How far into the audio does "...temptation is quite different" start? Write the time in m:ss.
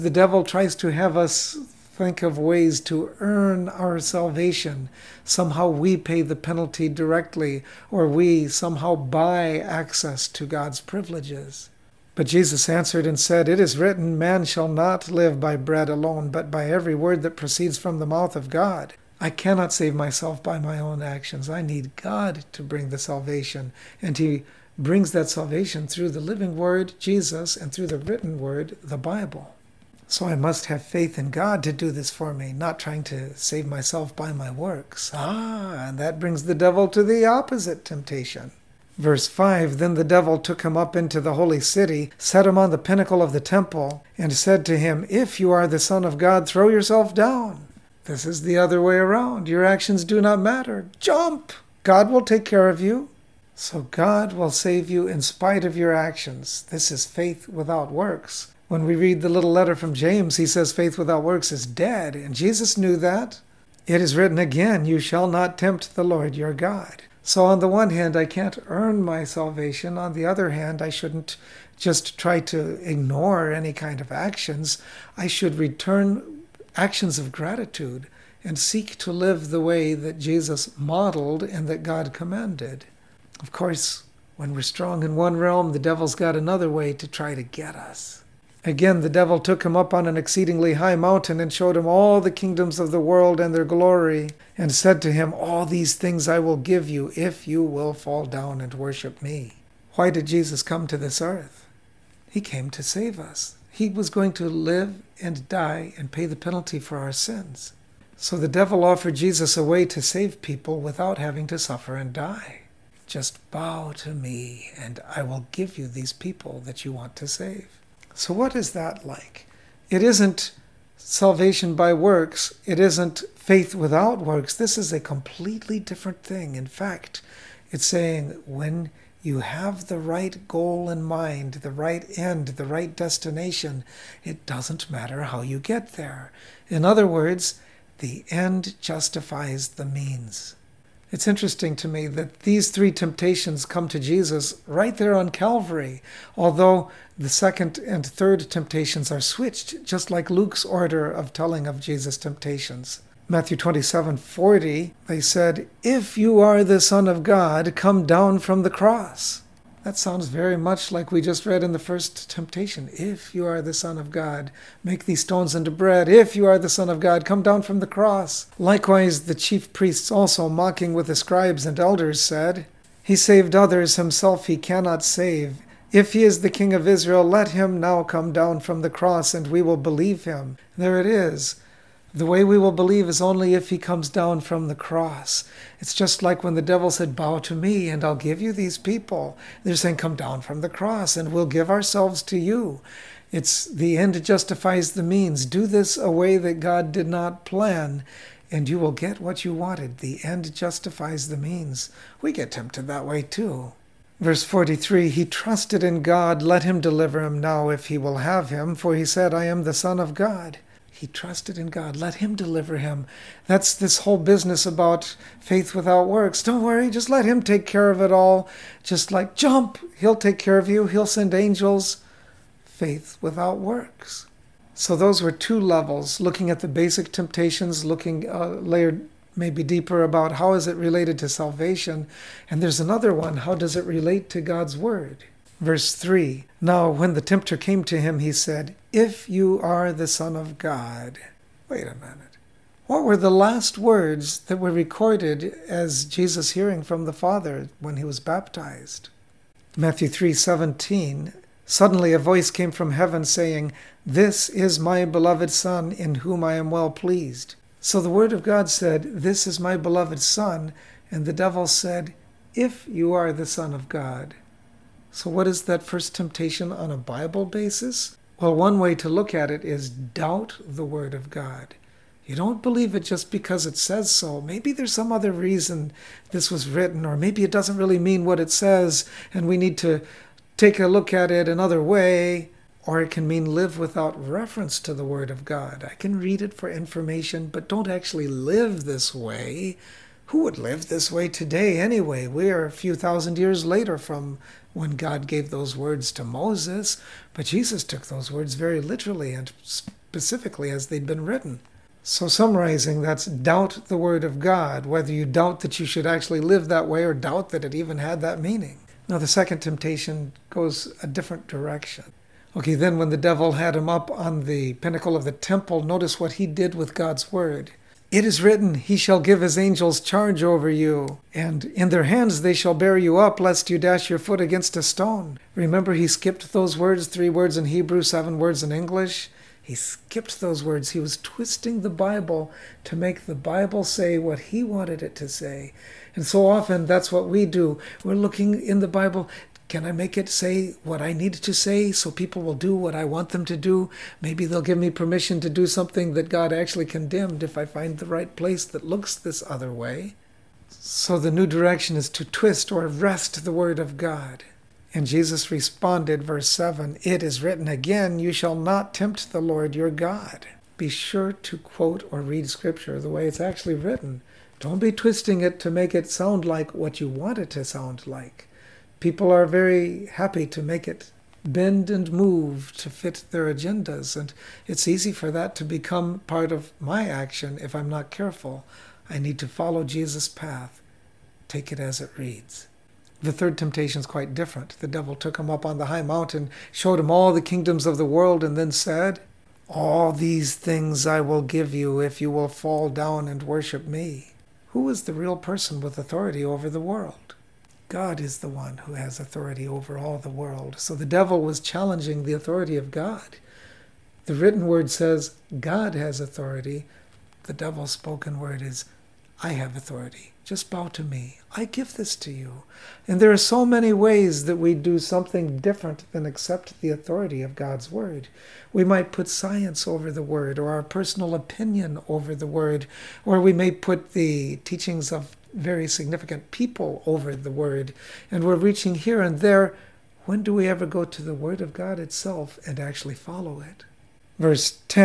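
6:23.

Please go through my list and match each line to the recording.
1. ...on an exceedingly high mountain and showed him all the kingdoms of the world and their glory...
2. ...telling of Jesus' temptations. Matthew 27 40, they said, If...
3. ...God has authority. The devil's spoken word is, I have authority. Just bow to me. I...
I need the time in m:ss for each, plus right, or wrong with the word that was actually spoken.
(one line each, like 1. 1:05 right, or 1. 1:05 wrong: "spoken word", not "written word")
1. 1:29 right
2. 2:31 right
3. 6:45 right.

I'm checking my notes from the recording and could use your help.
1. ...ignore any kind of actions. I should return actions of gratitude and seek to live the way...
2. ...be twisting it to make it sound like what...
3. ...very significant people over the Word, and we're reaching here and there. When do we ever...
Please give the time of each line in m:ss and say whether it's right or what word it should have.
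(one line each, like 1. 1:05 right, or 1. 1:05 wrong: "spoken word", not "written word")
1. 1:12 right
2. 6:04 right
3. 7:05 right.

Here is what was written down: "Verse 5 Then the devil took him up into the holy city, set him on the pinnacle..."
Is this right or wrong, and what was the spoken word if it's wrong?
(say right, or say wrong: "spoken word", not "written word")
right.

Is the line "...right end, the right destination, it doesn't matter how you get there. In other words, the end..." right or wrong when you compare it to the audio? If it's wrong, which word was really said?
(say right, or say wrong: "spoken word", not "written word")
right.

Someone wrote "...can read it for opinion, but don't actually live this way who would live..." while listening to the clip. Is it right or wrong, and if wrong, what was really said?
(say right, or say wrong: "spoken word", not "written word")
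wrong: "information", not "opinion".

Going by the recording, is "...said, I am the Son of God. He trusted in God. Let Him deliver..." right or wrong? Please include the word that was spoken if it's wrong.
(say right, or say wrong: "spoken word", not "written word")
right.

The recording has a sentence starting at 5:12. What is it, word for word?
Okay, then when the devil had him up on the pinnacle of the temple, notice what he did with God's Word.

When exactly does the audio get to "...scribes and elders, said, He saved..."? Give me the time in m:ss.
2:51.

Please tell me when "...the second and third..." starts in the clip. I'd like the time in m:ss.
2:27.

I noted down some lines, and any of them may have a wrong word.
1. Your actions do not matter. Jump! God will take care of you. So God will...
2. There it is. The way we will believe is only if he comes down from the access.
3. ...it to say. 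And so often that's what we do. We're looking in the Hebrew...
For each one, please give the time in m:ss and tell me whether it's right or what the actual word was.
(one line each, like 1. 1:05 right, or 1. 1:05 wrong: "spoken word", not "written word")
1. 0:49 right
2. 3:00 wrong: "cross", not "access"
3. 5:35 wrong: "Bible", not "Hebrew".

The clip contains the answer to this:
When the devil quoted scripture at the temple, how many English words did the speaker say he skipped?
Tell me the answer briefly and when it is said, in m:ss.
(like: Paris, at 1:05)
7, at 5:28.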